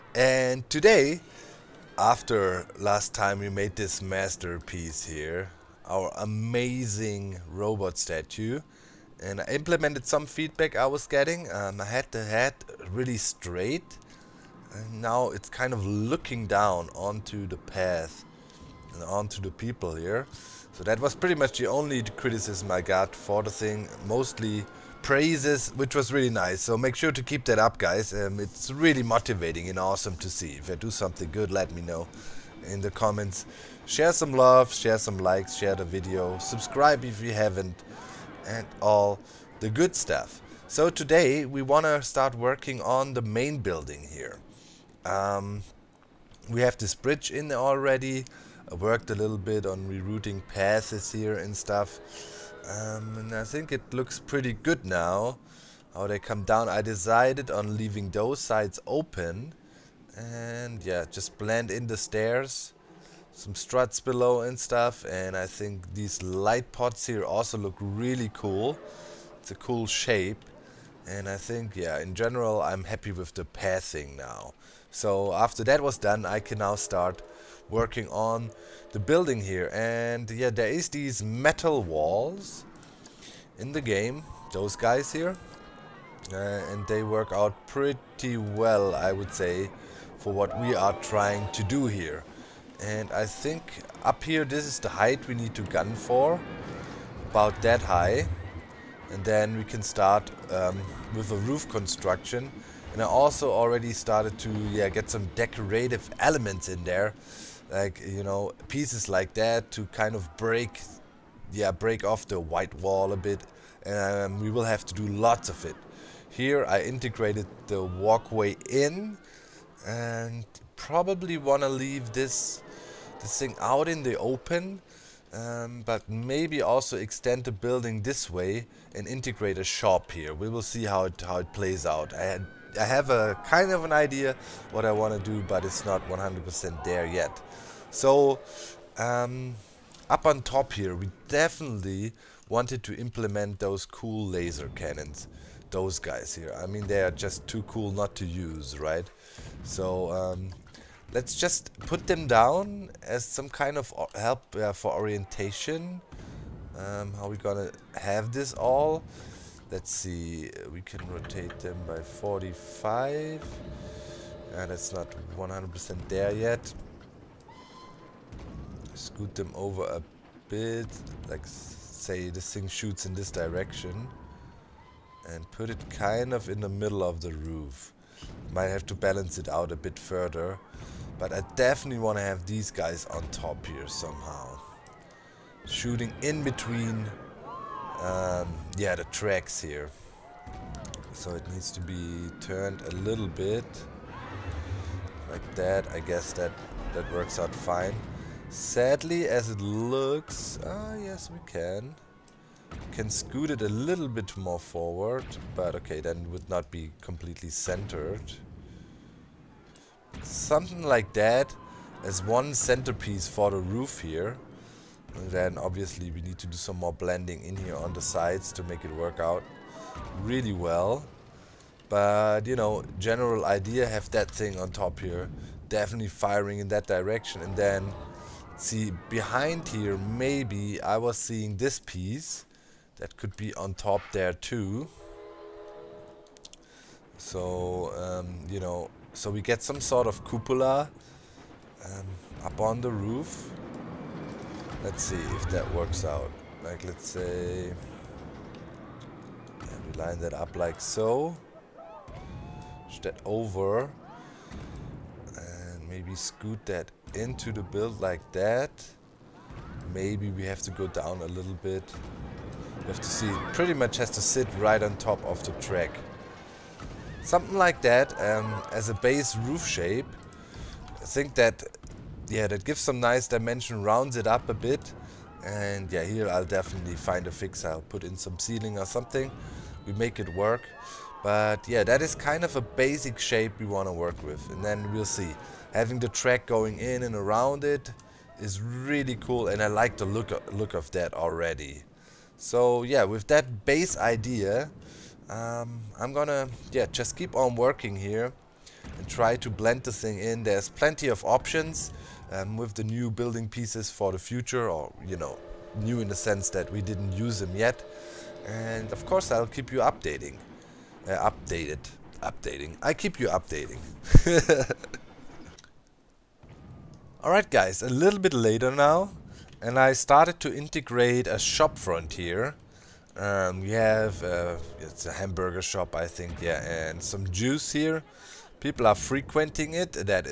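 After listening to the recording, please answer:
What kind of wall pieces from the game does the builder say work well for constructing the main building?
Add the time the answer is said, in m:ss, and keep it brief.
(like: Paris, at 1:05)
Metal walls, at 1:21.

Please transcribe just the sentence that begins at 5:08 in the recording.
And of course, I'll keep you updating.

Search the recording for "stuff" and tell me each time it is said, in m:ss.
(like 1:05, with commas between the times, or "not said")
0:39, 0:51, 1:04.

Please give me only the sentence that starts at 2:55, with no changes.
And put it kind of in the middle of the roof.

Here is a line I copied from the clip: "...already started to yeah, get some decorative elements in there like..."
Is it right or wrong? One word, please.
right.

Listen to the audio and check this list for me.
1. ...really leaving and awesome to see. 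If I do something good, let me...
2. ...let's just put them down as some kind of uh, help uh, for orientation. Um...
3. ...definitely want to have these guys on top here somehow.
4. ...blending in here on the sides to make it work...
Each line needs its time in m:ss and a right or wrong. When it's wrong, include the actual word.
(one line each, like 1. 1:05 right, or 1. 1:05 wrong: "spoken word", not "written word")
1. 0:28 wrong: "motivating", not "leaving"
2. 2:31 right
3. 3:01 right
4. 3:36 right.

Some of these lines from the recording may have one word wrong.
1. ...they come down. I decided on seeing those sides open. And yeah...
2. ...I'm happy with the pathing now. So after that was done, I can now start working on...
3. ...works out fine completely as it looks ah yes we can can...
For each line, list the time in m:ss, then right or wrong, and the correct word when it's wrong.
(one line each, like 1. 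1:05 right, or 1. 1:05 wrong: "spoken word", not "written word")
1. 0:56 wrong: "leaving", not "seeing"
2. 1:12 right
3. 3:17 wrong: "sadly", not "completely".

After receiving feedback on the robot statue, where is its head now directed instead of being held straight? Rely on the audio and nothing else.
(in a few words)
Down onto the path.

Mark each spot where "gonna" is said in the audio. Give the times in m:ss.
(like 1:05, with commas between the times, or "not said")
2:37, 4:56.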